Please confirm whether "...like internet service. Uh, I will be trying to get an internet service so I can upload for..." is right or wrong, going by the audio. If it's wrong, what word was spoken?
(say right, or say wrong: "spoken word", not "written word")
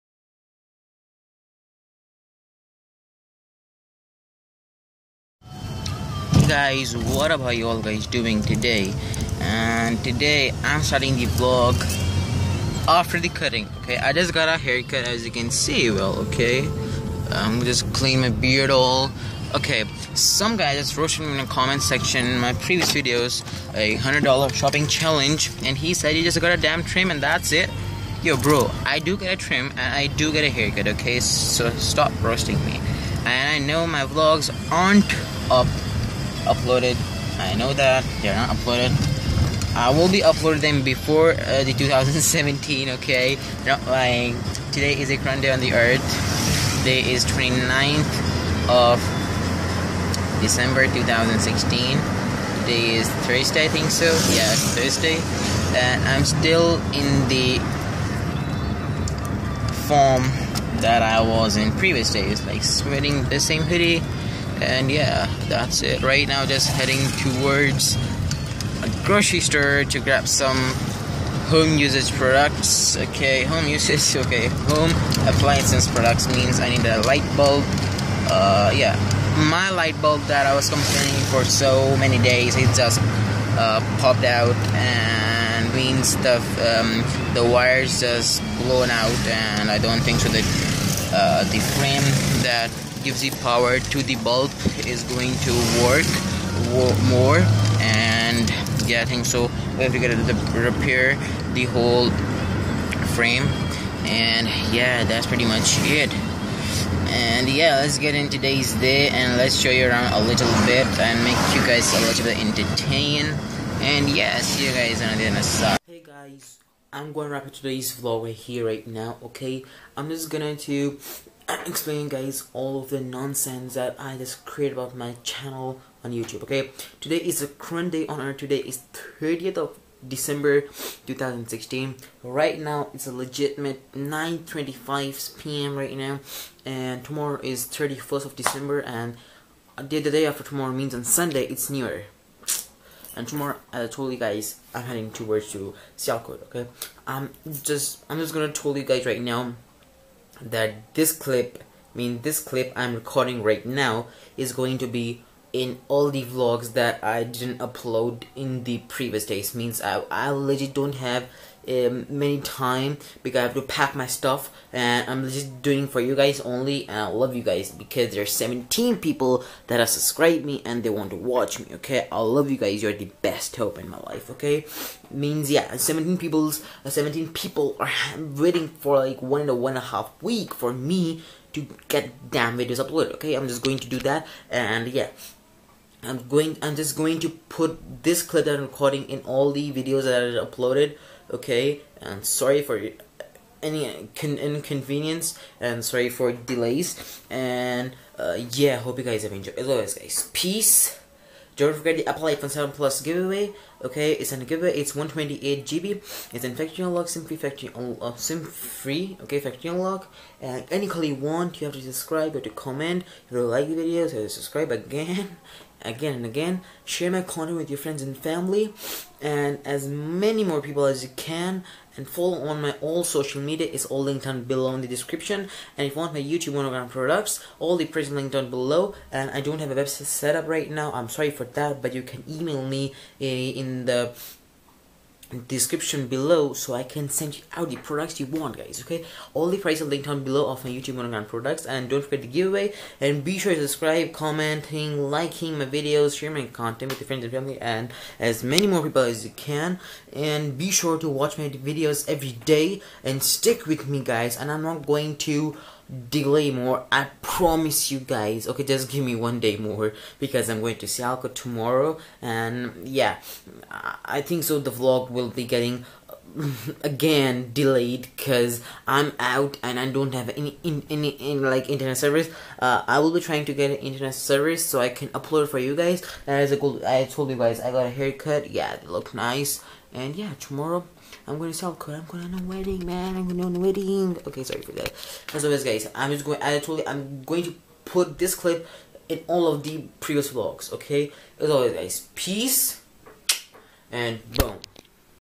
right.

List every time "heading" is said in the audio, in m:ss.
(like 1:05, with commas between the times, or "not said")
1:06, 2:24.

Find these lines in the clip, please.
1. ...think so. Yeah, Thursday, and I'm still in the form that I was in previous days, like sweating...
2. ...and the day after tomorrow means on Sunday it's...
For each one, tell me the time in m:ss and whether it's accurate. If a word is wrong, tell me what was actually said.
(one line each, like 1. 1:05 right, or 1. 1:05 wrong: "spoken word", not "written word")
1. 0:53 right
2. 2:18 right.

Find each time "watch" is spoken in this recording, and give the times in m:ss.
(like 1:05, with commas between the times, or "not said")
2:51, 4:11.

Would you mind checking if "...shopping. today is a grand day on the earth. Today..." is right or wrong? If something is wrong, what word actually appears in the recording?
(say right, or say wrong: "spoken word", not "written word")
wrong: "lying", not "shopping".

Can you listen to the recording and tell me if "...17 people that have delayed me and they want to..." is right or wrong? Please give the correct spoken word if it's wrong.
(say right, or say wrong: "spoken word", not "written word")
wrong: "subscribed", not "delayed".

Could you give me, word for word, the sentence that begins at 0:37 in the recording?
I know that they're not uploaded.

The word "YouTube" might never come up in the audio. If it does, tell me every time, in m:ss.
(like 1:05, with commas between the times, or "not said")
2:06, 3:46, 4:00.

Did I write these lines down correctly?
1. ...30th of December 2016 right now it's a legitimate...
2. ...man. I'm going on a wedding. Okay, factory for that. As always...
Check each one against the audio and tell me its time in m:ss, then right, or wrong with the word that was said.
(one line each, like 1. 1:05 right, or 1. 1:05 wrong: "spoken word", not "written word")
1. 2:09 right
2. 4:42 wrong: "sorry", not "factory".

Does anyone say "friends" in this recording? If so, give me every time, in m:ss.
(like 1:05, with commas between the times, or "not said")
3:37, 4:07.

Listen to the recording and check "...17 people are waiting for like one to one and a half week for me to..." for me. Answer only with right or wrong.
right.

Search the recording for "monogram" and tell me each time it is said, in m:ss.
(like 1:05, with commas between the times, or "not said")
3:46, 4:00.